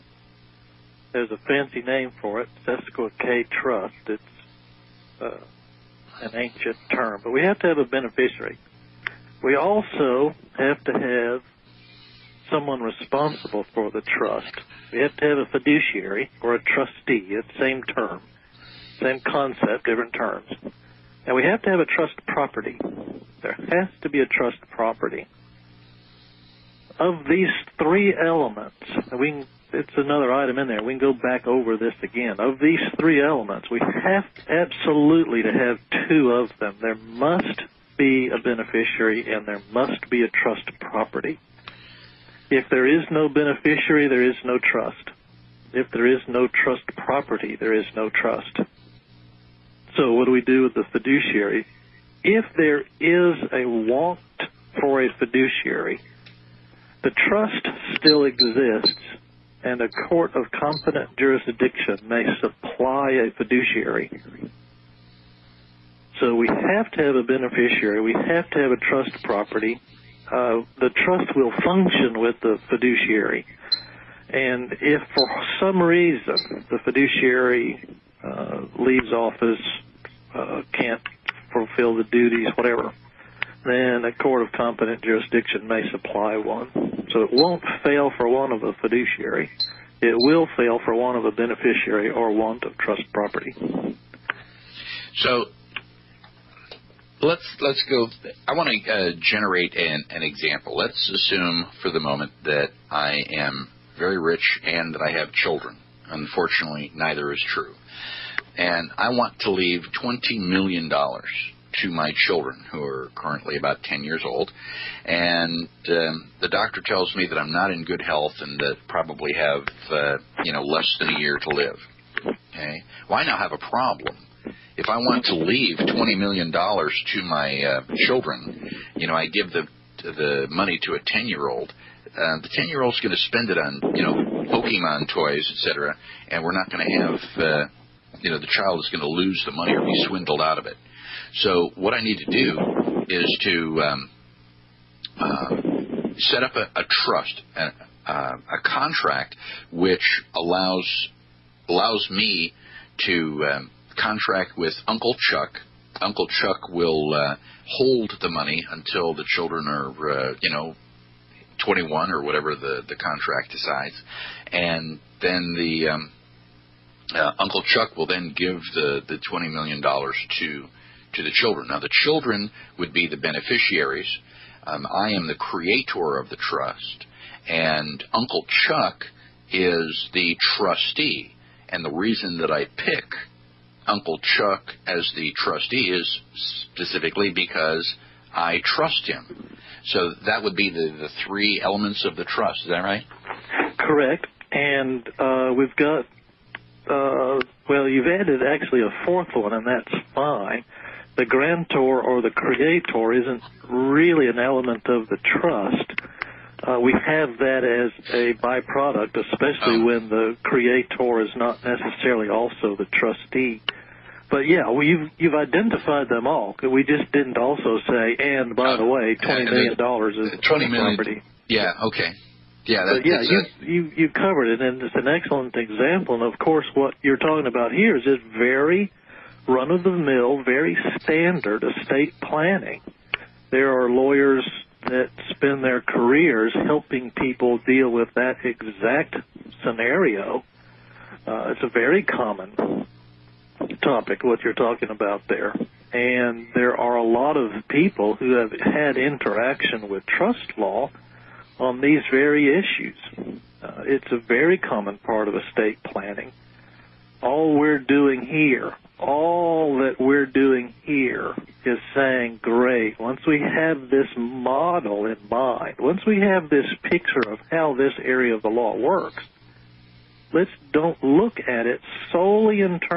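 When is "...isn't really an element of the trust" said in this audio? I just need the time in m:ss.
3:23.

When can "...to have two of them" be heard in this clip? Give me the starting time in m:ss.
0:35.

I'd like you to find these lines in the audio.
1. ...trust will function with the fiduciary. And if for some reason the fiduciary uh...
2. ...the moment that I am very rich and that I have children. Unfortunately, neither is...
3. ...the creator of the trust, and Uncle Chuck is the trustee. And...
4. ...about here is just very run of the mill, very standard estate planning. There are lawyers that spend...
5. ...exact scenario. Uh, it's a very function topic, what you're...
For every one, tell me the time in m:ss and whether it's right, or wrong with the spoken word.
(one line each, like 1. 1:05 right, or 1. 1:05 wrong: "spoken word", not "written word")
1. 1:11 right
2. 1:41 right
3. 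2:55 right
4. 3:47 right
5. 3:58 wrong: "common", not "function".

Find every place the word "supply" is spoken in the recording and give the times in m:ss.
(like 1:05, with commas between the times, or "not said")
1:02, 1:25.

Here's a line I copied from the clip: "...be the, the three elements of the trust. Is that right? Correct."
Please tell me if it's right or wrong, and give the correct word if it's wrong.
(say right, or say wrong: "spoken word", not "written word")
right.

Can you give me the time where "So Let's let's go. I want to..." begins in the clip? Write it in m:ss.
1:35.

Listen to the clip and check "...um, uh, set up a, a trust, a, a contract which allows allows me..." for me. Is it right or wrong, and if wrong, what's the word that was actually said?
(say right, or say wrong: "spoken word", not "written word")
right.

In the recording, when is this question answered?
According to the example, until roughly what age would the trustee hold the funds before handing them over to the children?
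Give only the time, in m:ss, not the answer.
2:41.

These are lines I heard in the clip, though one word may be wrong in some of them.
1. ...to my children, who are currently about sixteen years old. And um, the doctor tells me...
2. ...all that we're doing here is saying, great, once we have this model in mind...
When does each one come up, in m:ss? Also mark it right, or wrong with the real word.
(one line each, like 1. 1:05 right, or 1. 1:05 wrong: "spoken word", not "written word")
1. 1:51 wrong: "ten", not "sixteen"
2. 4:18 right.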